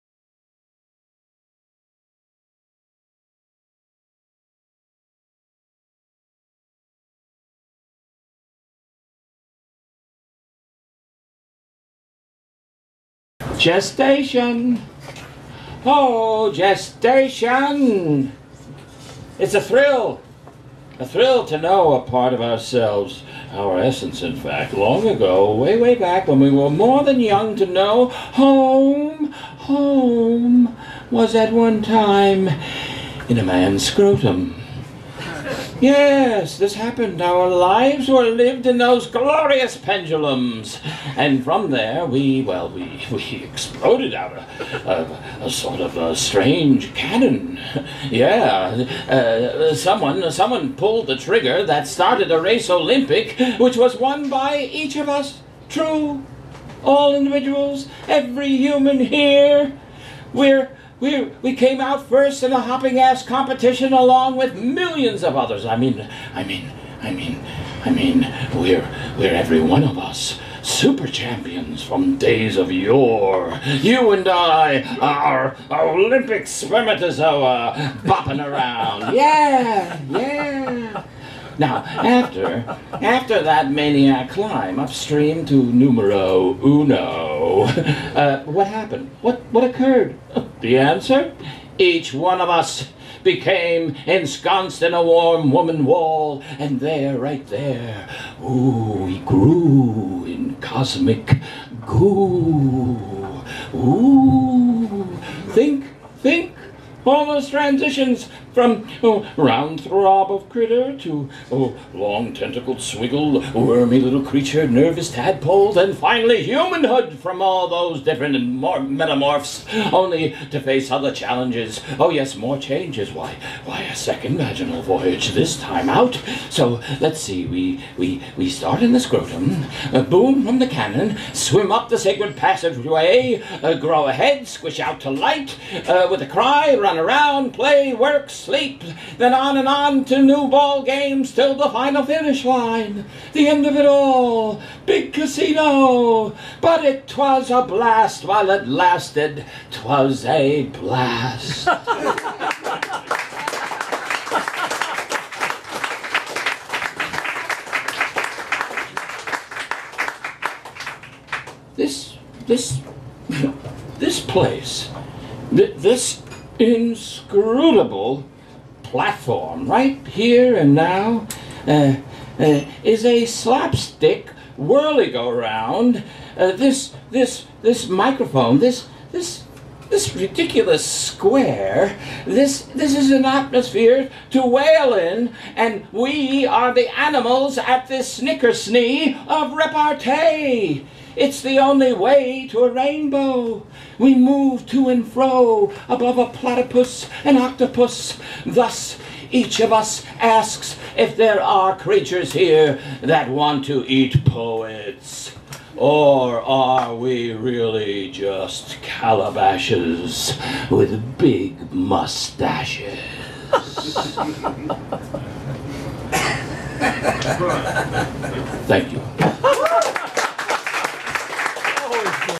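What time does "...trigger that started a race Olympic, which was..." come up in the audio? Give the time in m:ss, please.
0:51.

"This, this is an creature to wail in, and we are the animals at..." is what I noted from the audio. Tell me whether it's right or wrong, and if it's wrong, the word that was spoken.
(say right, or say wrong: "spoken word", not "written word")
wrong: "atmosphere", not "creature".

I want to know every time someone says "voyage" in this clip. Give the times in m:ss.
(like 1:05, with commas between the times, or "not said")
2:04.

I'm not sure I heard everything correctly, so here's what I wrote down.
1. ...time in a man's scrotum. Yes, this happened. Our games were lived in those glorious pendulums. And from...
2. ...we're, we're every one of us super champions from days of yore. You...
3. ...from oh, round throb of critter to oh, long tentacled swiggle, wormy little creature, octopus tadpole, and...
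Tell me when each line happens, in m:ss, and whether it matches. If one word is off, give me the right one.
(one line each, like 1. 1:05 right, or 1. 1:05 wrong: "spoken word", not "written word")
1. 0:31 wrong: "lives", not "games"
2. 1:08 right
3. 1:48 wrong: "nervous", not "octopus".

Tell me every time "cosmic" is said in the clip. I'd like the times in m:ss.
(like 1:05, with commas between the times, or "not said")
1:40.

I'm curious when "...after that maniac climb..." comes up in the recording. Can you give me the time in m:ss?
1:22.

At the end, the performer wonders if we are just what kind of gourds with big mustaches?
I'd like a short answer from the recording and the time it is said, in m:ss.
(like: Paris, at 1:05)
calabashes, at 3:28.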